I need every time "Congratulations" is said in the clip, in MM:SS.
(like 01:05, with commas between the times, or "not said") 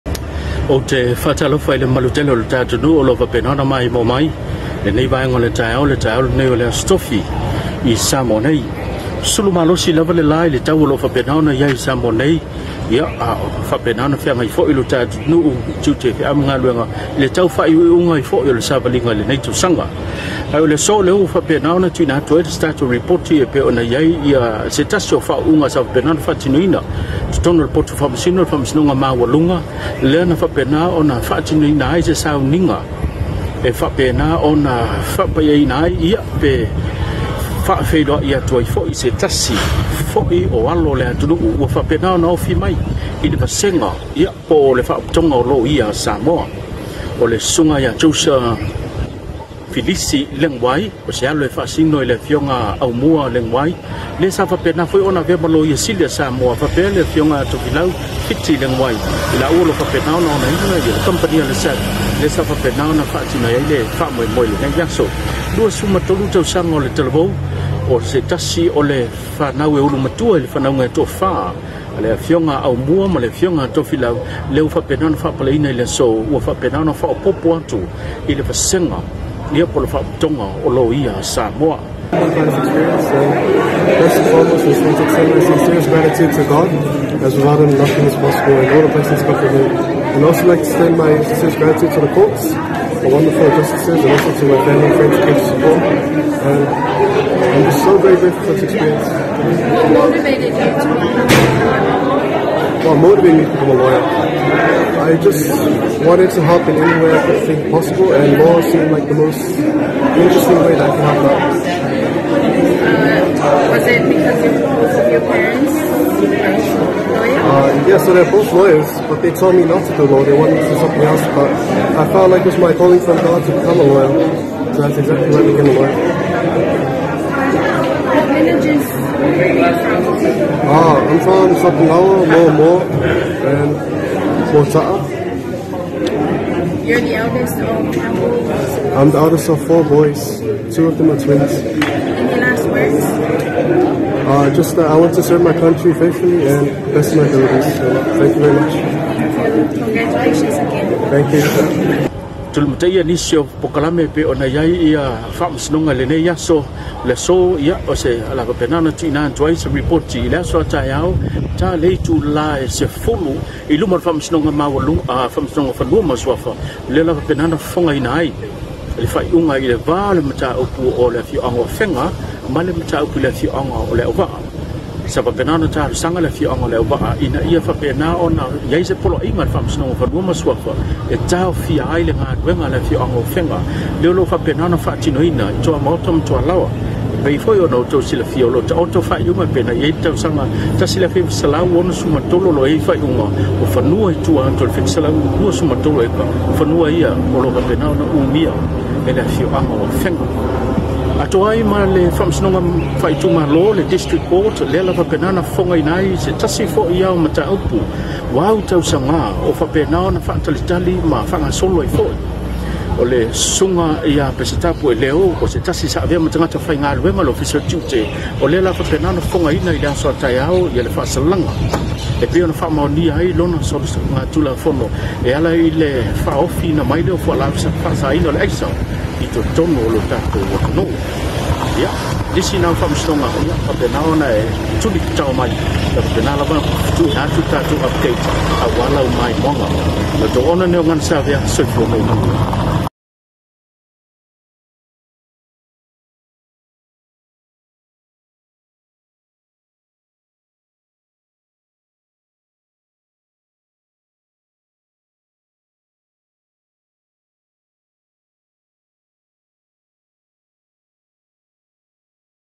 02:29.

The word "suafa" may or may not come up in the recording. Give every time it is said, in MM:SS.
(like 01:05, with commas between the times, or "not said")
02:46, 03:00.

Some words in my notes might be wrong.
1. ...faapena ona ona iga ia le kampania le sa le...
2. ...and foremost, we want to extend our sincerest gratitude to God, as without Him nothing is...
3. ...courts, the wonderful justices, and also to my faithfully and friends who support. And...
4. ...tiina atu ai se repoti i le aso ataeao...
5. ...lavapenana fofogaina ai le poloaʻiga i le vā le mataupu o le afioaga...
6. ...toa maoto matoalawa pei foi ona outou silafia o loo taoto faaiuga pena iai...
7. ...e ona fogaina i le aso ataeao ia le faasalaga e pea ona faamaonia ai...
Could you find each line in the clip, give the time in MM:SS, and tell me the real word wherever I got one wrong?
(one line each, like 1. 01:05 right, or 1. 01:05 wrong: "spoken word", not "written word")
1. 00:59 right
2. 01:24 right
3. 01:32 wrong: "family", not "faithfully"
4. 02:38 right
5. 02:47 wrong: "faiʻuga", not "poloaʻiga"
6. 03:05 right
7. 03:39 right.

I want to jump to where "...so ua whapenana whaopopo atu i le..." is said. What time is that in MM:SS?
01:15.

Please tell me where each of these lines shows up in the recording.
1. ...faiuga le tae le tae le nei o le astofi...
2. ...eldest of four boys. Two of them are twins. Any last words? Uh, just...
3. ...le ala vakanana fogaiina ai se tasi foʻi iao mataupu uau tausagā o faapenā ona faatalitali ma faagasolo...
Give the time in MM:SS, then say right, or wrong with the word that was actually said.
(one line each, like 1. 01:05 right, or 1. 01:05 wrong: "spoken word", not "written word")
1. 00:05 wrong: "vaenga", not "faiuga"
2. 02:19 right
3. 03:24 right.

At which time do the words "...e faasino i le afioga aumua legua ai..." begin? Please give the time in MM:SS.
00:51.